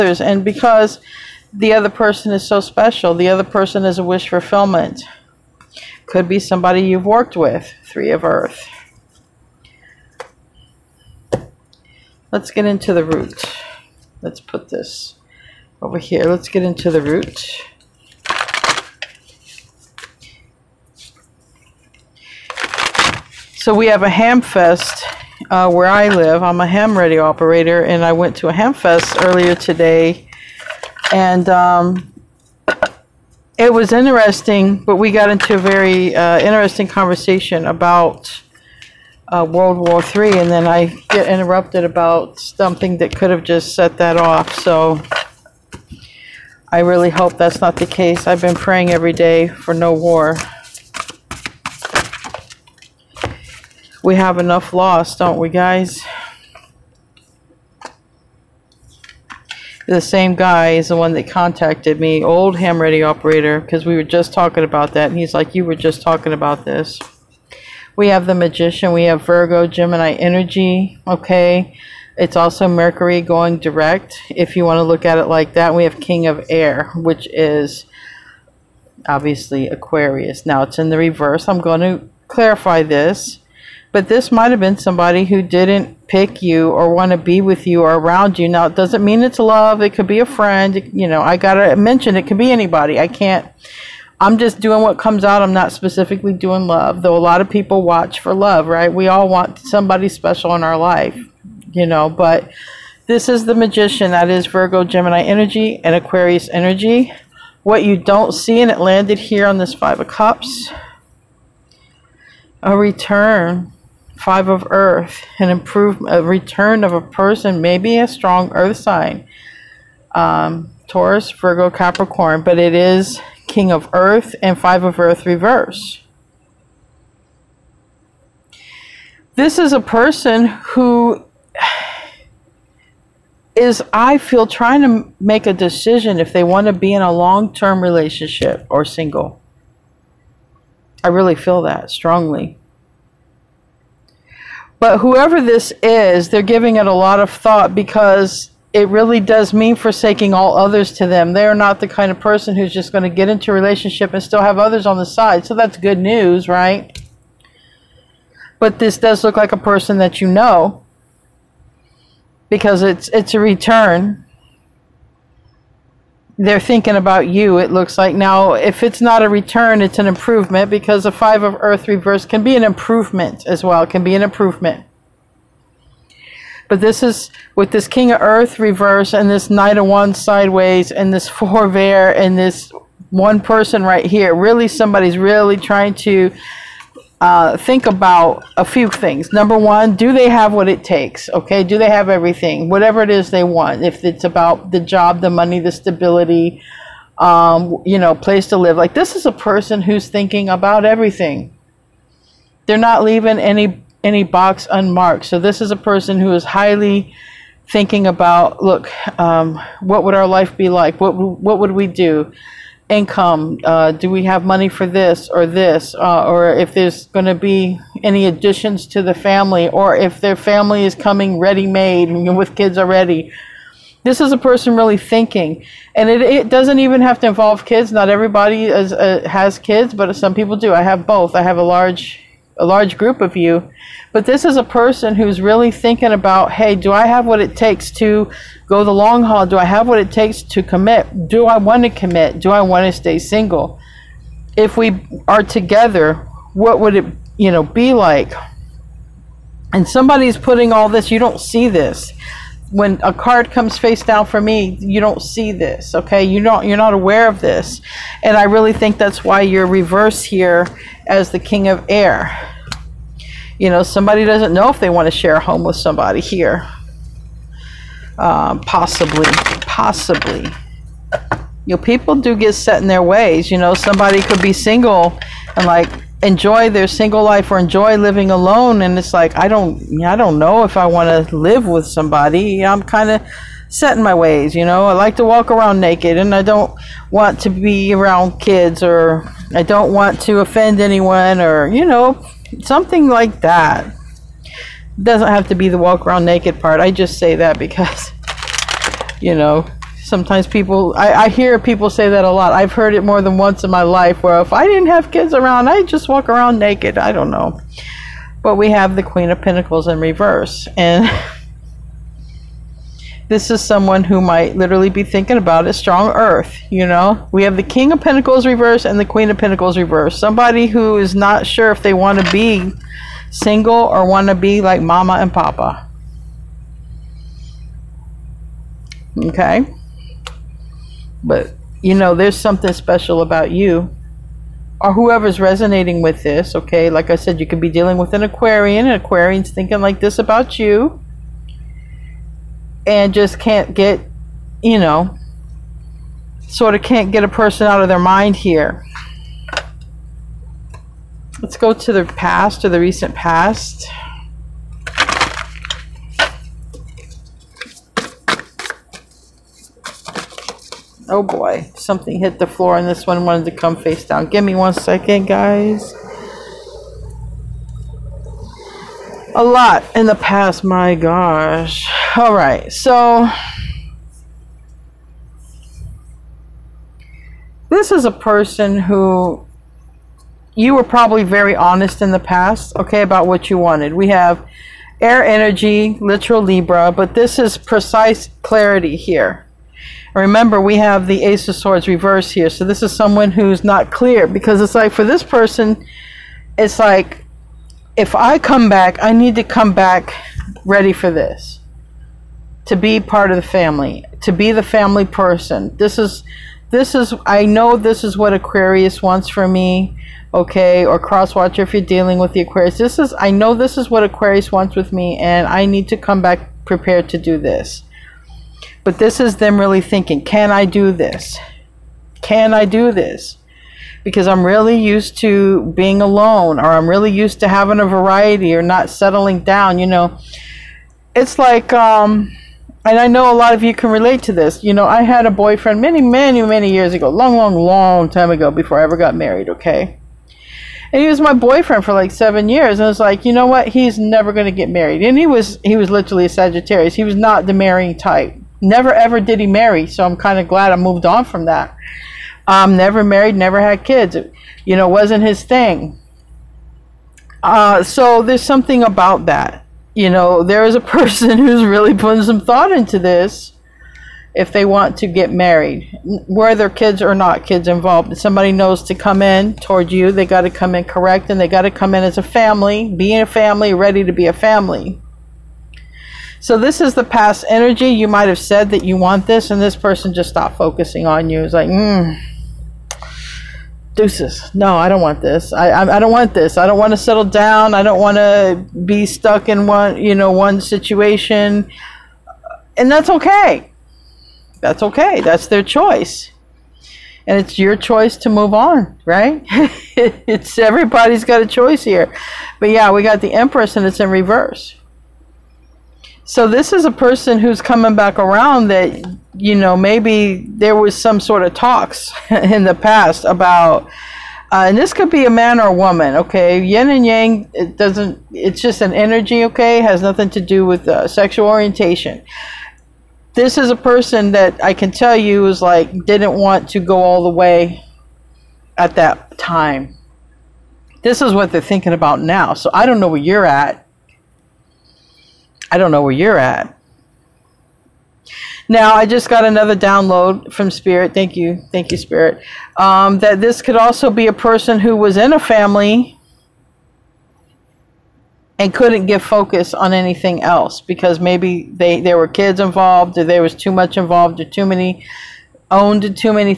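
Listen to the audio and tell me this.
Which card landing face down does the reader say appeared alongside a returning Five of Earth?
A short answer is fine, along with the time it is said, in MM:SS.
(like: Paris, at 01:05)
Five of Cups, at 01:49.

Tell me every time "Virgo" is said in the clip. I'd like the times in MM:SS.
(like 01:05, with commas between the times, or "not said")
01:09, 01:44, 02:01.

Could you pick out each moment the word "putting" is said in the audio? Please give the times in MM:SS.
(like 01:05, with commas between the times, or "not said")
04:10, 07:41.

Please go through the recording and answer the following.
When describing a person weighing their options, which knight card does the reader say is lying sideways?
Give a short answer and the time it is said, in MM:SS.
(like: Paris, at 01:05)
Knight of Wands, at 02:59.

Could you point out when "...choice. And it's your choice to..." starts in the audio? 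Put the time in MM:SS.
08:15.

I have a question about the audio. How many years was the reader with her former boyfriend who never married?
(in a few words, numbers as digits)
7.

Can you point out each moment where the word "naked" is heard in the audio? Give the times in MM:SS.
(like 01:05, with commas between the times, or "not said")
04:45, 04:56, 05:06.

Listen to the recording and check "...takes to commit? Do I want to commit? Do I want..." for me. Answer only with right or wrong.
right.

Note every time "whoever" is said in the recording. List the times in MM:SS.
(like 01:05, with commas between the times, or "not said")
02:24, 05:34.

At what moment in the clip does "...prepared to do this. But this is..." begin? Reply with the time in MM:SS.
06:56.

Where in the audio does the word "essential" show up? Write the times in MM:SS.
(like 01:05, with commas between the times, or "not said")
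not said.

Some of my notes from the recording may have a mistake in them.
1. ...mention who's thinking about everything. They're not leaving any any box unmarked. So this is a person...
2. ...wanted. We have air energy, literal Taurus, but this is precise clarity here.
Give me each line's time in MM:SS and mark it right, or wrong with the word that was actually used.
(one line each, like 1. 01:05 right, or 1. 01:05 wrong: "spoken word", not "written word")
1. 03:19 wrong: "person", not "mention"
2. 06:23 wrong: "Libra", not "Taurus".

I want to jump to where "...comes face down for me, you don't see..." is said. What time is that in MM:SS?
04:13.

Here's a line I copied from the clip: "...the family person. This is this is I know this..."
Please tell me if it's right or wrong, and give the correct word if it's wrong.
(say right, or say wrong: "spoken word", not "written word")
right.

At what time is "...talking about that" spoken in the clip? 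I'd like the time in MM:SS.
01:04.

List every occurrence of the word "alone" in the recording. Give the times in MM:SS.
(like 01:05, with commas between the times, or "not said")
04:38, 07:06.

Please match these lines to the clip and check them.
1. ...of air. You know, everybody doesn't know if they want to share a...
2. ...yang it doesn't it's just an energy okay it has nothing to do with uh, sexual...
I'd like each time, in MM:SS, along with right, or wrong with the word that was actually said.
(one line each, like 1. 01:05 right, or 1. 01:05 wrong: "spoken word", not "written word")
1. 04:21 wrong: "somebody", not "everybody"
2. 08:37 right.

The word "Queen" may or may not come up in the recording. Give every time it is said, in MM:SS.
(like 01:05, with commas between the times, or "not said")
05:09, 05:19.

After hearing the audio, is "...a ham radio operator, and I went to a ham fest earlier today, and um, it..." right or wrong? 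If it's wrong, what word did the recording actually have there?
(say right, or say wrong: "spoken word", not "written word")
right.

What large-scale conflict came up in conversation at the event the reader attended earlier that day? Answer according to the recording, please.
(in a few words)
World War Three.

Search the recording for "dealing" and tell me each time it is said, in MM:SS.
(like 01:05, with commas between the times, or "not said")
05:37, 06:51.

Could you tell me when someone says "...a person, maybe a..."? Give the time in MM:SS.
01:56.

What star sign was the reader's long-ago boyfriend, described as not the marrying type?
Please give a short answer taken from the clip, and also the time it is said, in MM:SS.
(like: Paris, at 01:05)
Sagittarius, at 07:26.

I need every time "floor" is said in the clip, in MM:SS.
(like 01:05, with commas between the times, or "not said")
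06:02.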